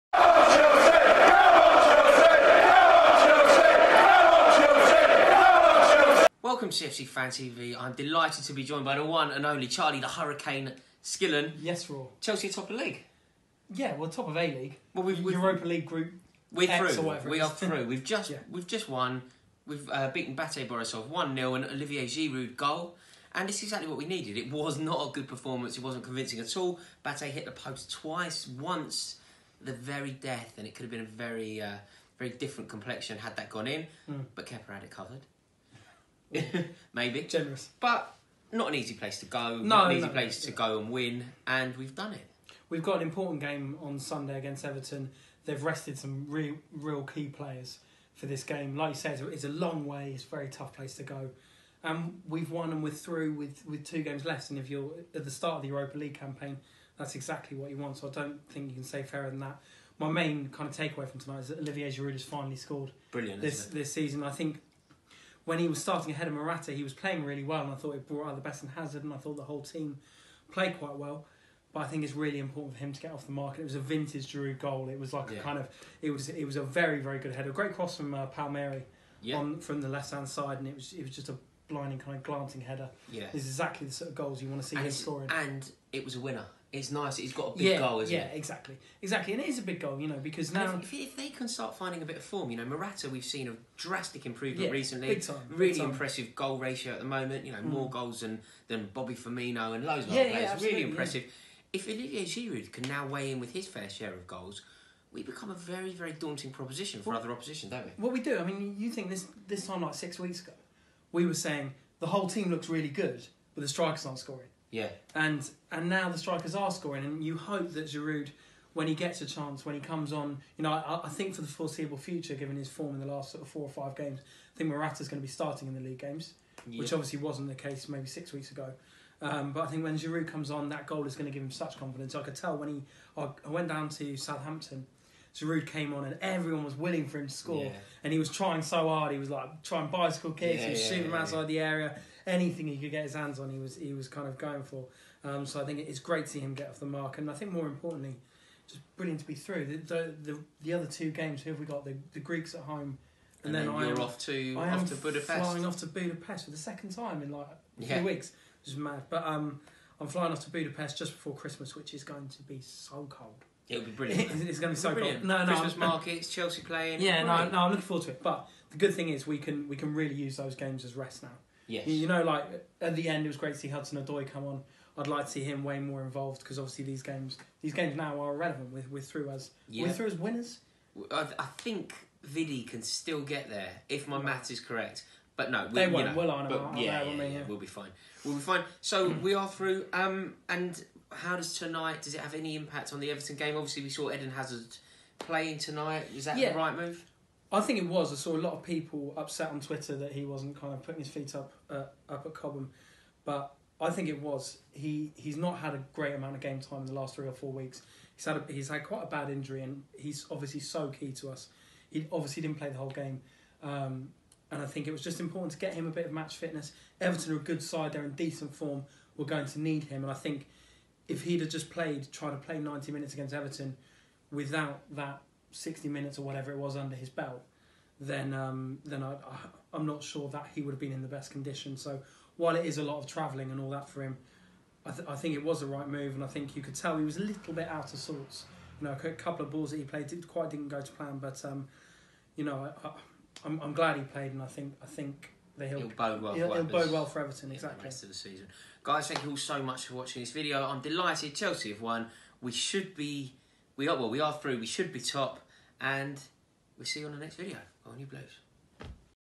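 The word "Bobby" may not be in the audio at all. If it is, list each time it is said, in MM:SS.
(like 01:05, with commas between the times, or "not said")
01:38.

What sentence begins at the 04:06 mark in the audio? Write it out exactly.
It'll, for it'll bode well for Everton exactly.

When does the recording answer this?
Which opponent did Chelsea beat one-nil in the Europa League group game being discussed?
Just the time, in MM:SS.
00:20.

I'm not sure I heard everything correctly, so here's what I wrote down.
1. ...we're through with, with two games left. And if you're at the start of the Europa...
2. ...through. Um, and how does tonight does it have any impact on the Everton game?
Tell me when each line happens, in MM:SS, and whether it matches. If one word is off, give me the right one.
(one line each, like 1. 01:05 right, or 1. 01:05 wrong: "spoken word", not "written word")
1. 00:52 right
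2. 03:09 right.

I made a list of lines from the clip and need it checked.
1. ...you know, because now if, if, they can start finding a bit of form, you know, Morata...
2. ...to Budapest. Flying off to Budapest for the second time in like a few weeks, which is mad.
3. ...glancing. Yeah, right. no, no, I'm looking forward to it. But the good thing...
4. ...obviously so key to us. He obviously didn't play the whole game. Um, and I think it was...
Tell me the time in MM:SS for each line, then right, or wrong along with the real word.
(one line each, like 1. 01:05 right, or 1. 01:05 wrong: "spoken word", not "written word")
1. 01:29 right
2. 02:34 right
3. 02:46 wrong: "playing", not "glancing"
4. 03:30 right.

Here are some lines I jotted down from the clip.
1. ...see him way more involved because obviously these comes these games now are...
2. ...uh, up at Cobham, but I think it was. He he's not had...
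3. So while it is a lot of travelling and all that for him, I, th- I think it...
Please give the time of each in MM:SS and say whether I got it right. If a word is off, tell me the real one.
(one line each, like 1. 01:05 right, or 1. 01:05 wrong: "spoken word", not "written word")
1. 02:55 wrong: "games", not "comes"
2. 03:21 right
3. 03:51 right.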